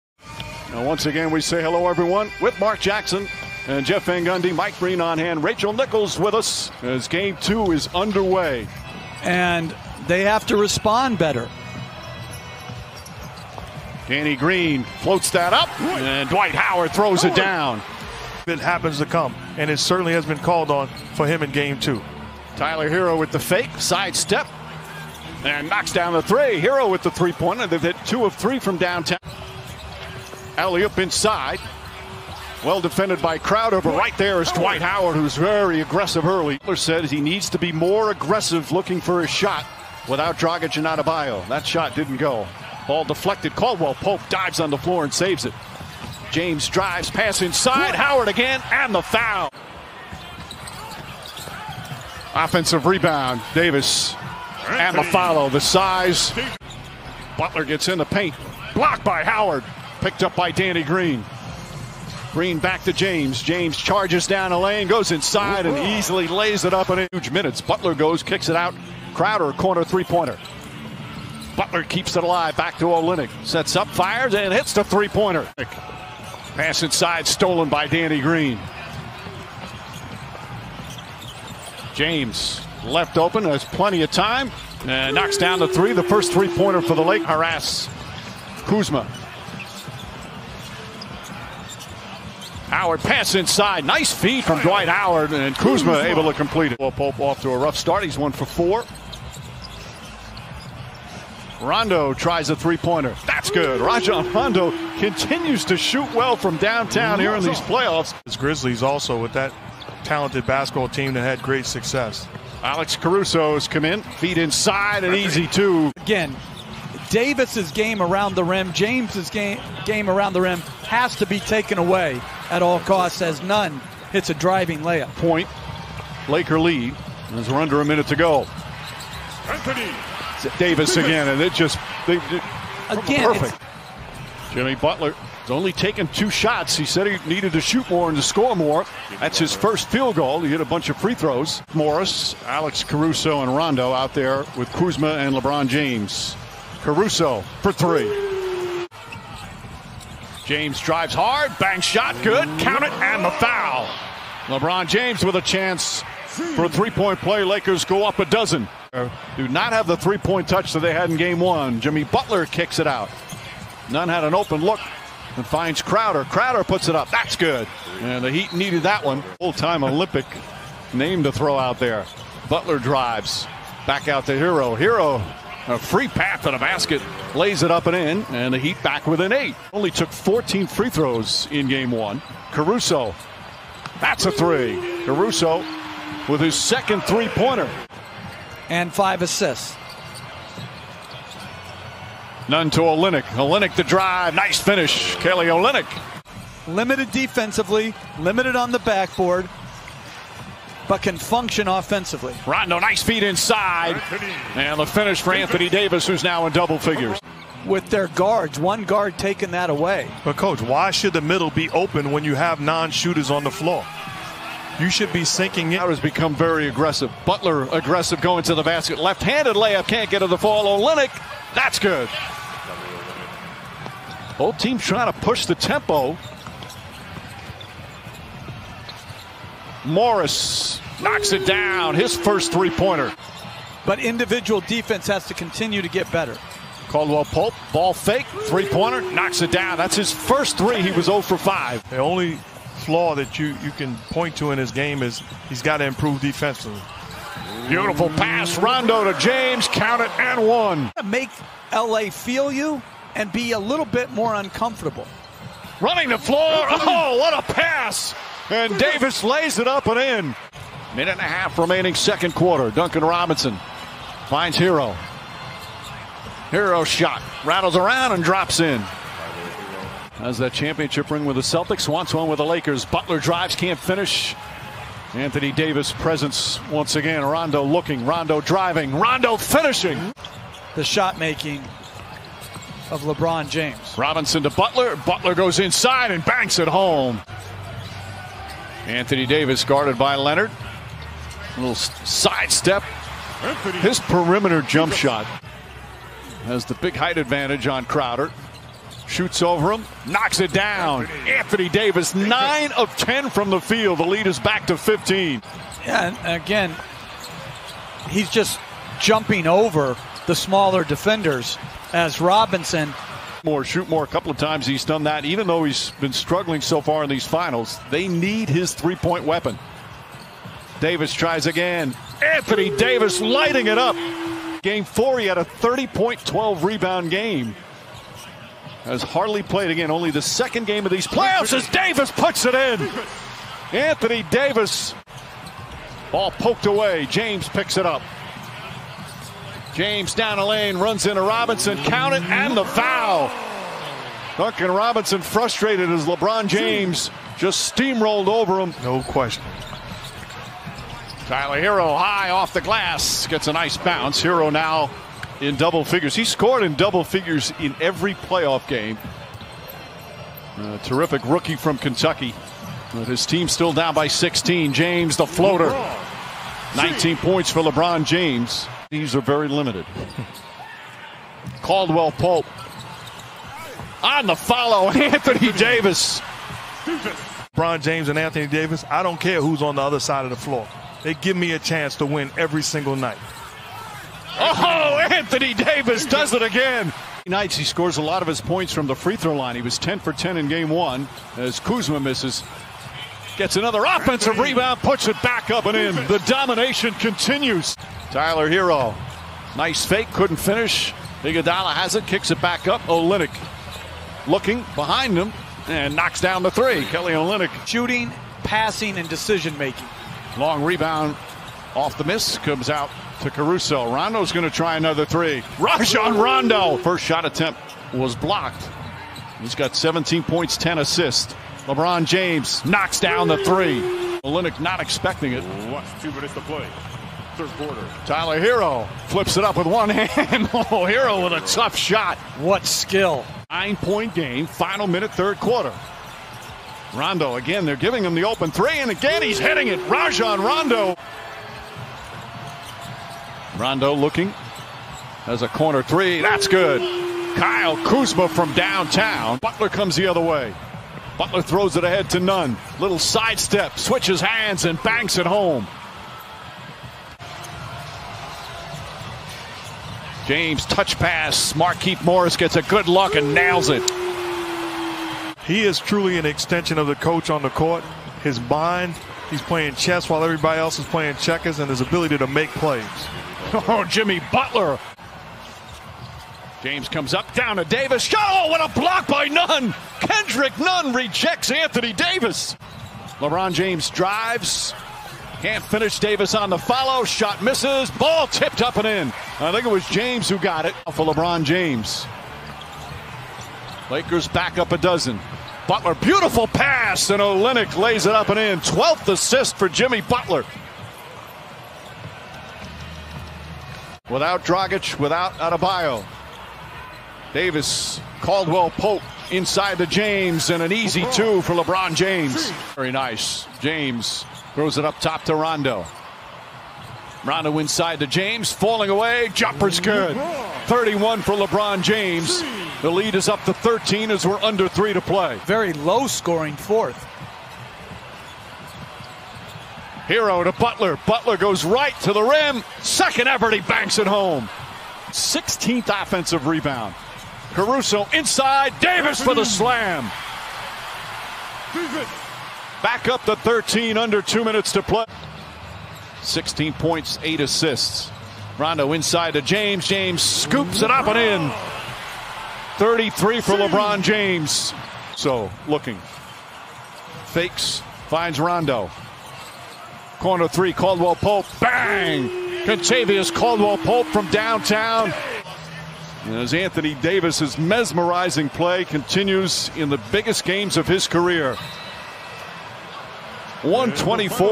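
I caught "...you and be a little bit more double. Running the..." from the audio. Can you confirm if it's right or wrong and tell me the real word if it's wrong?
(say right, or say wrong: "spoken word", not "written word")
wrong: "uncomfortable", not "double".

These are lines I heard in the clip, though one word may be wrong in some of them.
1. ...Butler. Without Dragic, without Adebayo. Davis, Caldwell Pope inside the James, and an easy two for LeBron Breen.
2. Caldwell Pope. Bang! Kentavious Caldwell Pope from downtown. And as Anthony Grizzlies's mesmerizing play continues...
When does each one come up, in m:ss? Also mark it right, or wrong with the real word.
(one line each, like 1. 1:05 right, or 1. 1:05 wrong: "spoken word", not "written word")
1. 8:20 wrong: "James", not "Breen"
2. 9:20 wrong: "Davis", not "Grizzlies".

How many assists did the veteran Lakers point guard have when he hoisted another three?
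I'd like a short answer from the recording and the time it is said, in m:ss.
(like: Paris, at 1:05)
10, at 7:00.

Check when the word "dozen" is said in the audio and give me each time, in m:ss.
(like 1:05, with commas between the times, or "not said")
2:38, 8:14.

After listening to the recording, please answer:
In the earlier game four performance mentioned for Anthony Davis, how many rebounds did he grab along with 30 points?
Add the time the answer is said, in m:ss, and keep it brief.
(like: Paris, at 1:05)
12, at 5:26.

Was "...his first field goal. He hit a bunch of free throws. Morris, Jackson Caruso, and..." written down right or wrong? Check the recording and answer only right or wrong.
wrong.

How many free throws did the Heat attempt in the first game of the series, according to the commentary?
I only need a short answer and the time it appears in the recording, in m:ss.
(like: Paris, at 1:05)
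14, at 3:00.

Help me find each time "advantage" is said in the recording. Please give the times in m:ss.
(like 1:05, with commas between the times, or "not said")
4:57.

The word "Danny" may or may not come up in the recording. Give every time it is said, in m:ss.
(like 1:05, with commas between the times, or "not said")
0:14, 1:00, 1:17.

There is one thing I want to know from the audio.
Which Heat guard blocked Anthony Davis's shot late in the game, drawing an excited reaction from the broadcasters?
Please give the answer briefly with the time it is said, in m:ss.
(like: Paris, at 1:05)
Kendrick Nunn, at 7:59.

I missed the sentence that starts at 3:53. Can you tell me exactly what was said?
But individual defense has to continue to get better.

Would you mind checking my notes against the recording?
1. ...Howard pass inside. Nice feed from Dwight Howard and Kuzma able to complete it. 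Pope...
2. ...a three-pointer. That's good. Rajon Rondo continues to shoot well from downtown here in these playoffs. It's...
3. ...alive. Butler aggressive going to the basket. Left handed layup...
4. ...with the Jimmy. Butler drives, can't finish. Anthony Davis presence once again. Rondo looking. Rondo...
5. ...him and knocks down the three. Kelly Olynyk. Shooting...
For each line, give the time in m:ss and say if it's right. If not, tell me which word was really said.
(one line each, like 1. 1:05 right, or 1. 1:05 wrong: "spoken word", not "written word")
1. 1:32 right
2. 1:42 right
3. 3:36 wrong: "aggressive", not "alive"
4. 4:32 wrong: "Lakers", not "Jimmy"
5. 6:45 right.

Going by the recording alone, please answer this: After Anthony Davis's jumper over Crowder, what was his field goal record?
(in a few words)
9 of 10.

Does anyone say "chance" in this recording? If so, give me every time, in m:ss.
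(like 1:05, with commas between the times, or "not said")
2:35, 6:21.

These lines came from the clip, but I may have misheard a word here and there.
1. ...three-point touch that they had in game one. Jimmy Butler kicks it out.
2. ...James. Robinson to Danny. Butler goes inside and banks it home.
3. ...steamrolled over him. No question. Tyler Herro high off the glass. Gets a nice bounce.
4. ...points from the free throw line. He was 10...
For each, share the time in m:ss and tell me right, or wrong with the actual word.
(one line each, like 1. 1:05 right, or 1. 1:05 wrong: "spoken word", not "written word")
1. 2:39 right
2. 4:43 wrong: "Butler", not "Danny"
3. 5:47 right
4. 6:28 right.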